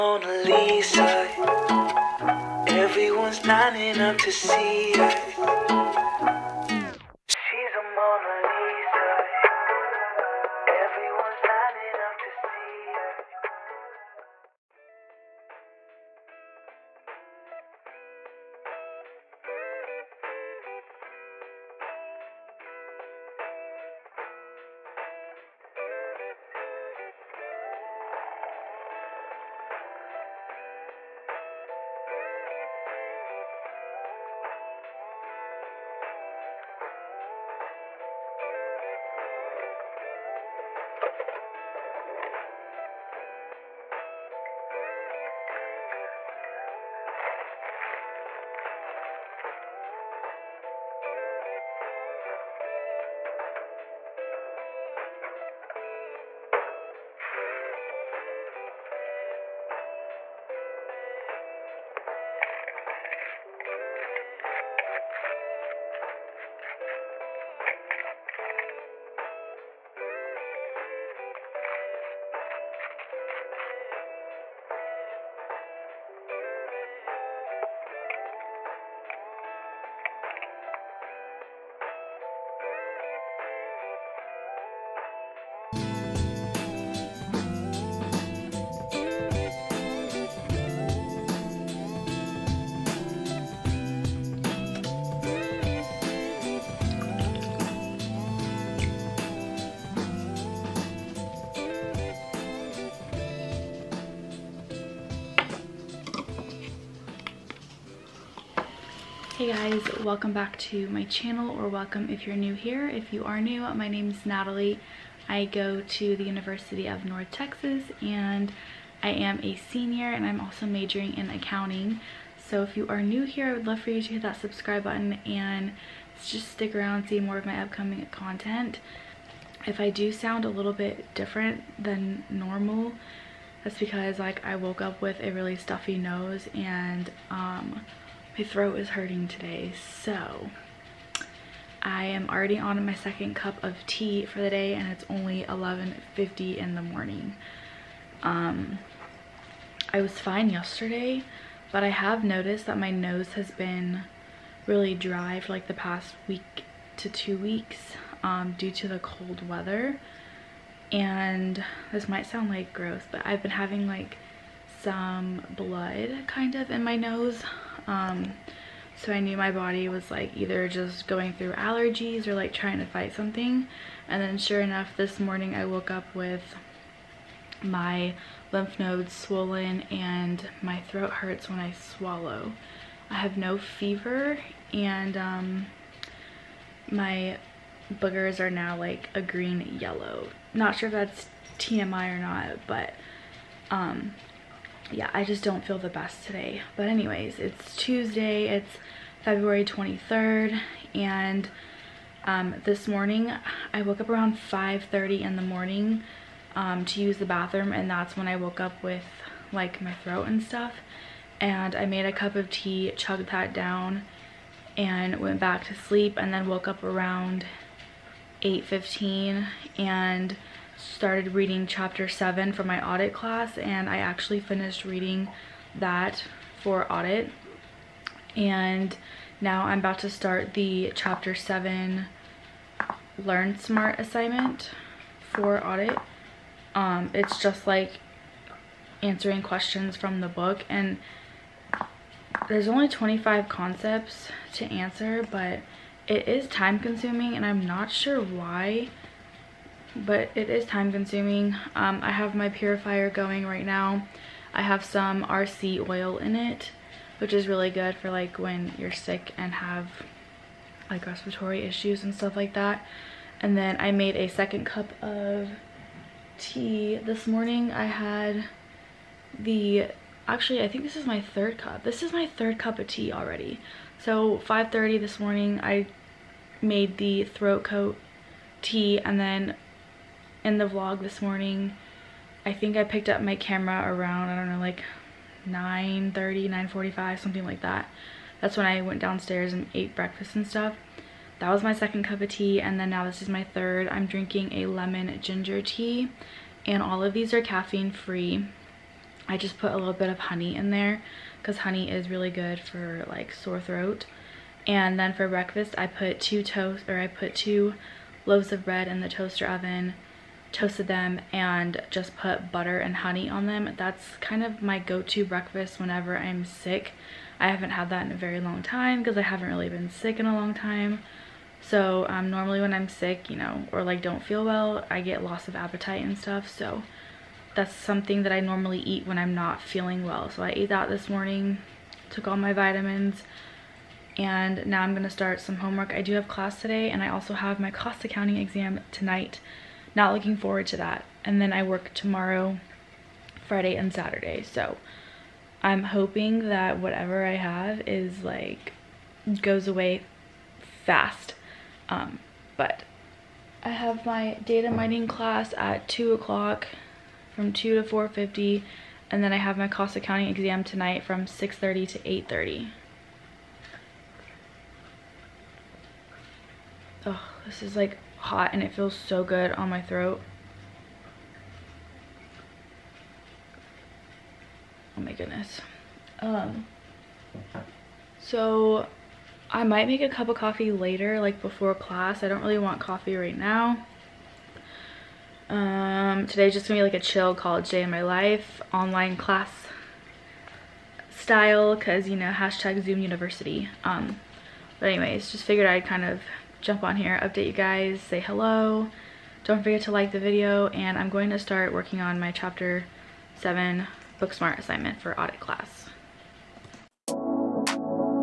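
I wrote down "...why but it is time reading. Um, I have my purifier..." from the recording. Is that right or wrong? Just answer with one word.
wrong.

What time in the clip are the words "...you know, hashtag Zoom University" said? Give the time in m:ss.
6:32.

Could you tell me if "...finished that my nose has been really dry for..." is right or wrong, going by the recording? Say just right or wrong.
wrong.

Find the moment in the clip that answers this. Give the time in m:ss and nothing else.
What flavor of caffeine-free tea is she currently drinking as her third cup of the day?
4:54.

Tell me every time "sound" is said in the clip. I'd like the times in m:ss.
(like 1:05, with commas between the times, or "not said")
2:10, 2:42.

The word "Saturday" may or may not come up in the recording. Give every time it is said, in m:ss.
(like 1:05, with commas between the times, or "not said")
5:43.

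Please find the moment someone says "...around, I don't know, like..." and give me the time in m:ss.
4:43.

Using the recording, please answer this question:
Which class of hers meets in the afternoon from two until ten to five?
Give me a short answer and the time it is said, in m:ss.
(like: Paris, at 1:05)
Data mining, at 5:54.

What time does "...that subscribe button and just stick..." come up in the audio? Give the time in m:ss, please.
2:04.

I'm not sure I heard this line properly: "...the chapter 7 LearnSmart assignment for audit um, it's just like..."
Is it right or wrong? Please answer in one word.
right.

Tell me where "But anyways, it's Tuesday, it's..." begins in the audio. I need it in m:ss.
3:16.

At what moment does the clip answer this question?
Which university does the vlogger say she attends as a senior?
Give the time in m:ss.
1:56.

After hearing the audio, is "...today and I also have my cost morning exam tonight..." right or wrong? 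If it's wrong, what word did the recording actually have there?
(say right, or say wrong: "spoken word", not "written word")
wrong: "accounting", not "morning".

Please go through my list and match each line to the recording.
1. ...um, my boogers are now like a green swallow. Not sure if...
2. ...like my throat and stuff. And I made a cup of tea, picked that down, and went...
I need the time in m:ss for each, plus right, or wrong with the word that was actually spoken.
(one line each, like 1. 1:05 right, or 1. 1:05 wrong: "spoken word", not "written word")
1. 3:05 wrong: "yellow", not "swallow"
2. 3:29 wrong: "chugged", not "picked".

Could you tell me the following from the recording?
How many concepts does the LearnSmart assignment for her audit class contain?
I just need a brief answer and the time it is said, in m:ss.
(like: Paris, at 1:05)
25, at 4:02.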